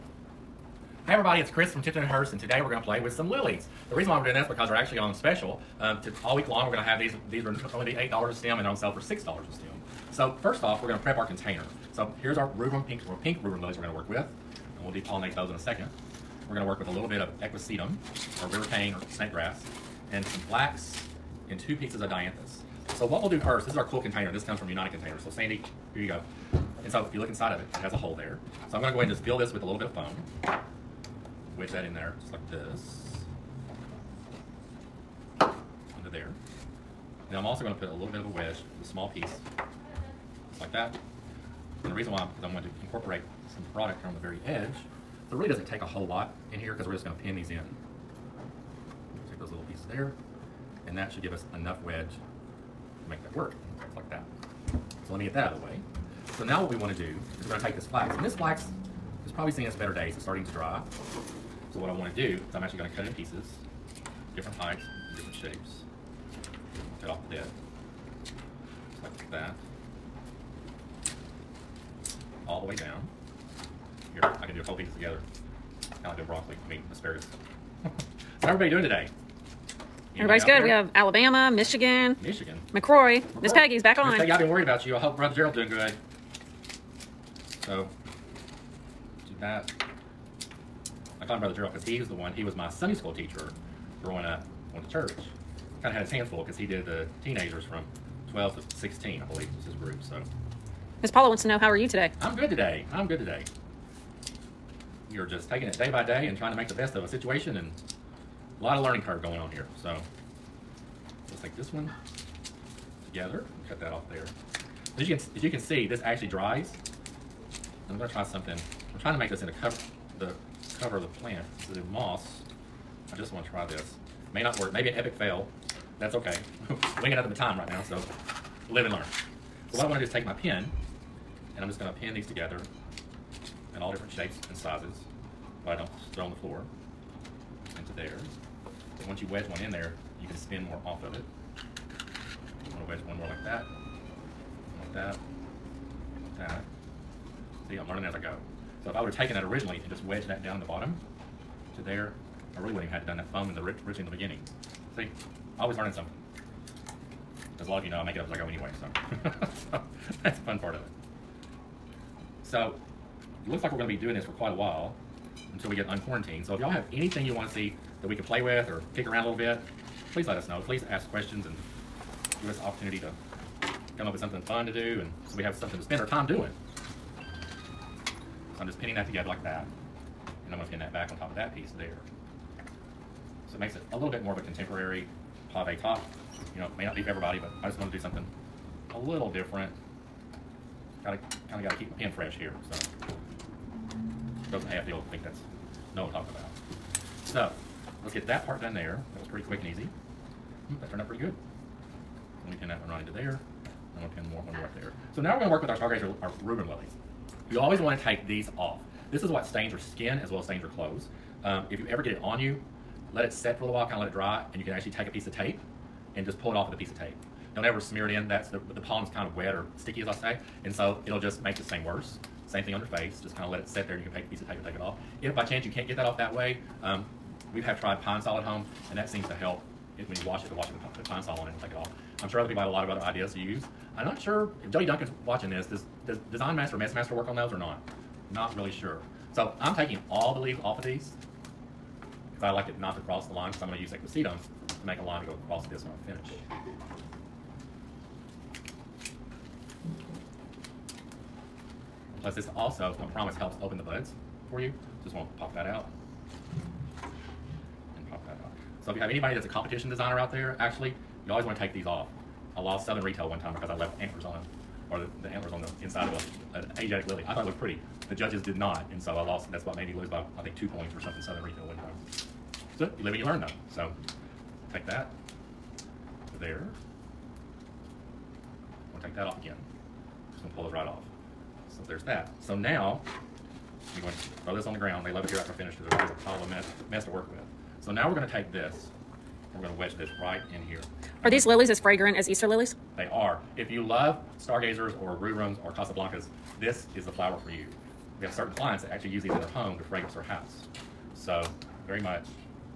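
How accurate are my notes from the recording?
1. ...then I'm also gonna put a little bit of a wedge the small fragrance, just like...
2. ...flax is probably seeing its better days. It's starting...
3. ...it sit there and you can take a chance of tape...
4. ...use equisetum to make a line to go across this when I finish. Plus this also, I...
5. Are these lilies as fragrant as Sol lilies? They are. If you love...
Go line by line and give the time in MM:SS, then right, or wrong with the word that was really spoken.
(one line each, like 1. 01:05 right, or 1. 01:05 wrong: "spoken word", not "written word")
1. 00:37 wrong: "piece", not "fragrance"
2. 00:58 right
3. 03:43 wrong: "piece", not "chance"
4. 04:03 right
5. 04:51 wrong: "Easter", not "Sol".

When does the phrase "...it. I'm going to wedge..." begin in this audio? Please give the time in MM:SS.
02:21.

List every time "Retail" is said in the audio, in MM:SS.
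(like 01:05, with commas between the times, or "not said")
04:23, 04:31.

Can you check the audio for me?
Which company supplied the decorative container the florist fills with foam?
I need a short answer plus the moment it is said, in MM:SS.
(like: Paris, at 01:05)
United Containers, at 00:24.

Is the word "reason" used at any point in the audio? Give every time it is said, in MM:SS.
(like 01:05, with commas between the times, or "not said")
00:03, 00:41.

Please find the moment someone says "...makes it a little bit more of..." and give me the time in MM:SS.
03:03.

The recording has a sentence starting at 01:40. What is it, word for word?
So, Miss Paula wants to know, how are you today?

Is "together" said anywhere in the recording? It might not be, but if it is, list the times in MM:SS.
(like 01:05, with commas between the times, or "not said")
01:14, 01:53, 02:12, 02:59.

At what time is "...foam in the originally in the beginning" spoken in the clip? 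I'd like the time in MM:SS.
02:33.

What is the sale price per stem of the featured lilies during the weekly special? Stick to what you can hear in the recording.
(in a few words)
$6.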